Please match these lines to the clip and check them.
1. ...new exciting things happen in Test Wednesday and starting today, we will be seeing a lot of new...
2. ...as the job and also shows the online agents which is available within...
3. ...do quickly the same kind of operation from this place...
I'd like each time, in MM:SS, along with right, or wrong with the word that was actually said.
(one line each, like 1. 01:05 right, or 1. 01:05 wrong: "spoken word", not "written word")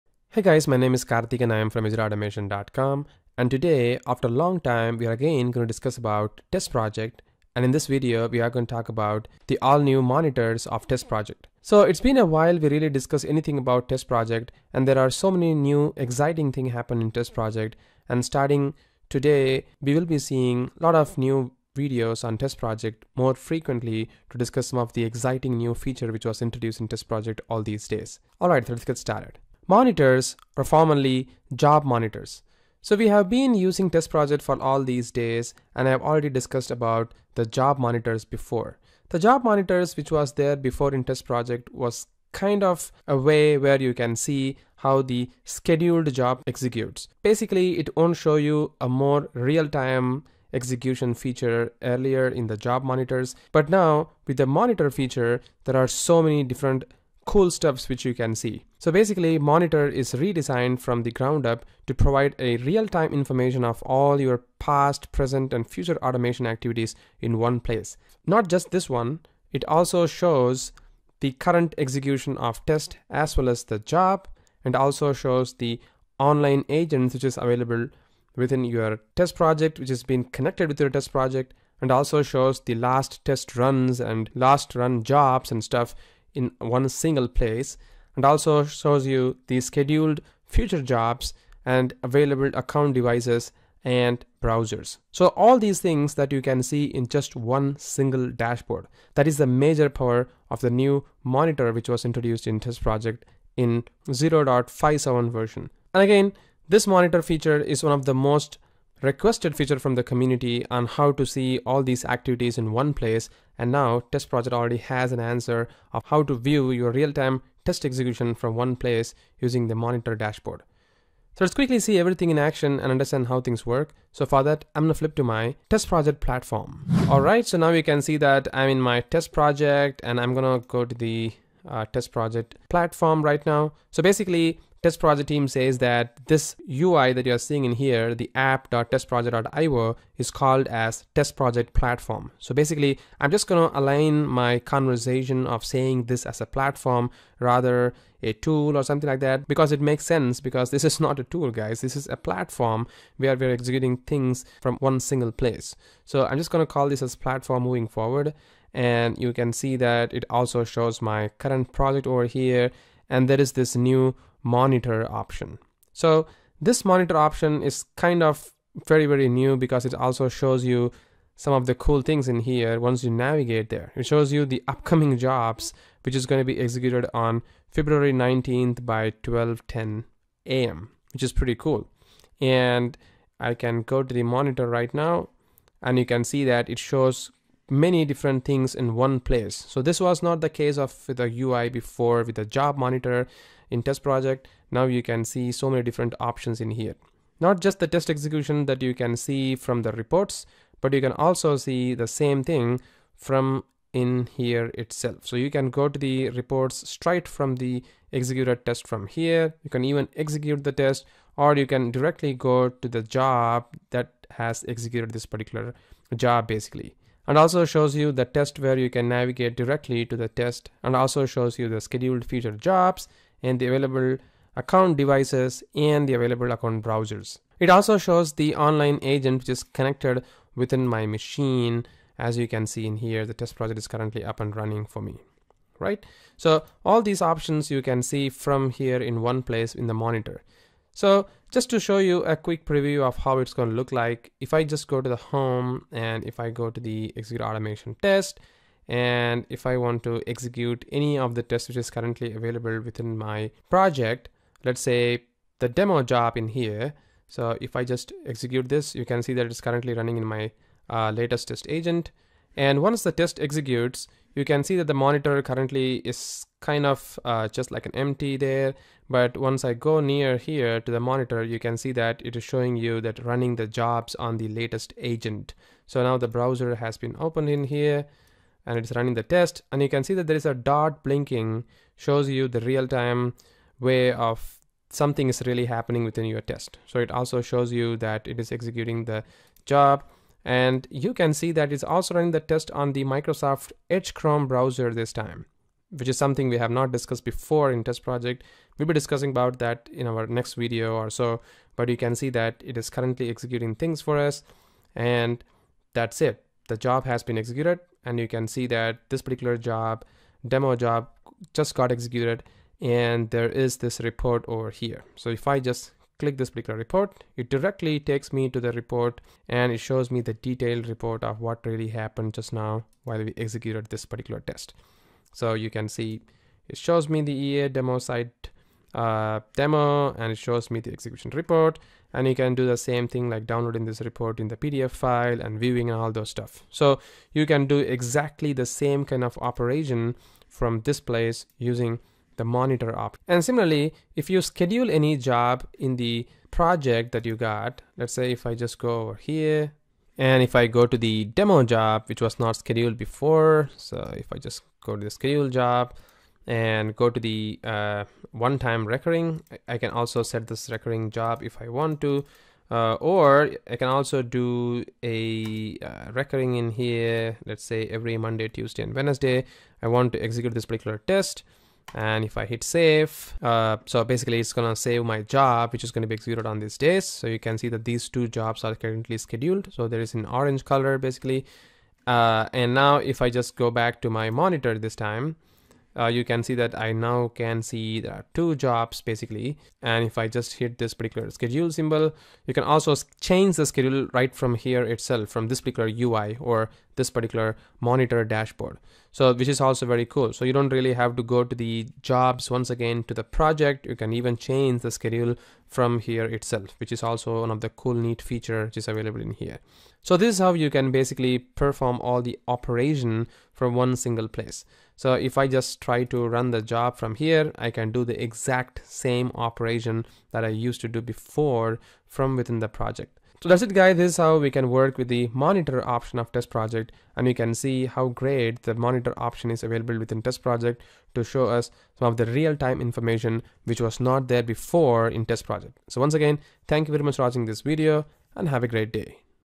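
1. 00:15 wrong: "Project", not "Wednesday"
2. 01:13 right
3. 05:37 wrong: "exactly", not "quickly".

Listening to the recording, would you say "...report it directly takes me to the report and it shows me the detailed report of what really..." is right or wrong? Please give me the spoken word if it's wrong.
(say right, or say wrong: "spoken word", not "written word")
right.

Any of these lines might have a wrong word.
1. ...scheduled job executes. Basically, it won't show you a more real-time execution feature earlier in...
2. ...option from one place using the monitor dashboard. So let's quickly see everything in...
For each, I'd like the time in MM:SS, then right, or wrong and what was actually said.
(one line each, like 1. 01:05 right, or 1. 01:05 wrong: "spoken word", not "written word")
1. 00:45 right
2. 01:57 wrong: "execution", not "option".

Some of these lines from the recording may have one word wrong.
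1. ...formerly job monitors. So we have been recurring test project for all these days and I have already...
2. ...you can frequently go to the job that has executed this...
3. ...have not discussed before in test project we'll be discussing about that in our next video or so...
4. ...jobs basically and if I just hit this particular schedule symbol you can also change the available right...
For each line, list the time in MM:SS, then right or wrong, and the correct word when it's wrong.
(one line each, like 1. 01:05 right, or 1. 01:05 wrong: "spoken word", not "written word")
1. 00:30 wrong: "using", not "recurring"
2. 03:31 wrong: "directly", not "frequently"
3. 04:56 right
4. 06:28 wrong: "schedule", not "available".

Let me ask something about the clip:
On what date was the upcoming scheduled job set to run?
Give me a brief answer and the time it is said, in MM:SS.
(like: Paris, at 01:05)
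February 19th, at 02:57.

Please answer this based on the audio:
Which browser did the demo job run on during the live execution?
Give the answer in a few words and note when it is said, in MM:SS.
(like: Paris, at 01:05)
Microsoft Edge Chromium, at 04:53.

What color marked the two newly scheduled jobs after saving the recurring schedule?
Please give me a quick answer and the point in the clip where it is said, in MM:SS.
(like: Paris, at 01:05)
Orange, at 06:20.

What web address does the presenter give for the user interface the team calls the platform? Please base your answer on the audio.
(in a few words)
app.testproject.io.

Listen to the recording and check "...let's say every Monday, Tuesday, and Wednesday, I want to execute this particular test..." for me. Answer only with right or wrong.
right.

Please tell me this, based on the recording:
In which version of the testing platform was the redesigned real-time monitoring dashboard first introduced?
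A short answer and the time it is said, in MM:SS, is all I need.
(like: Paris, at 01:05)
0.57, at 01:44.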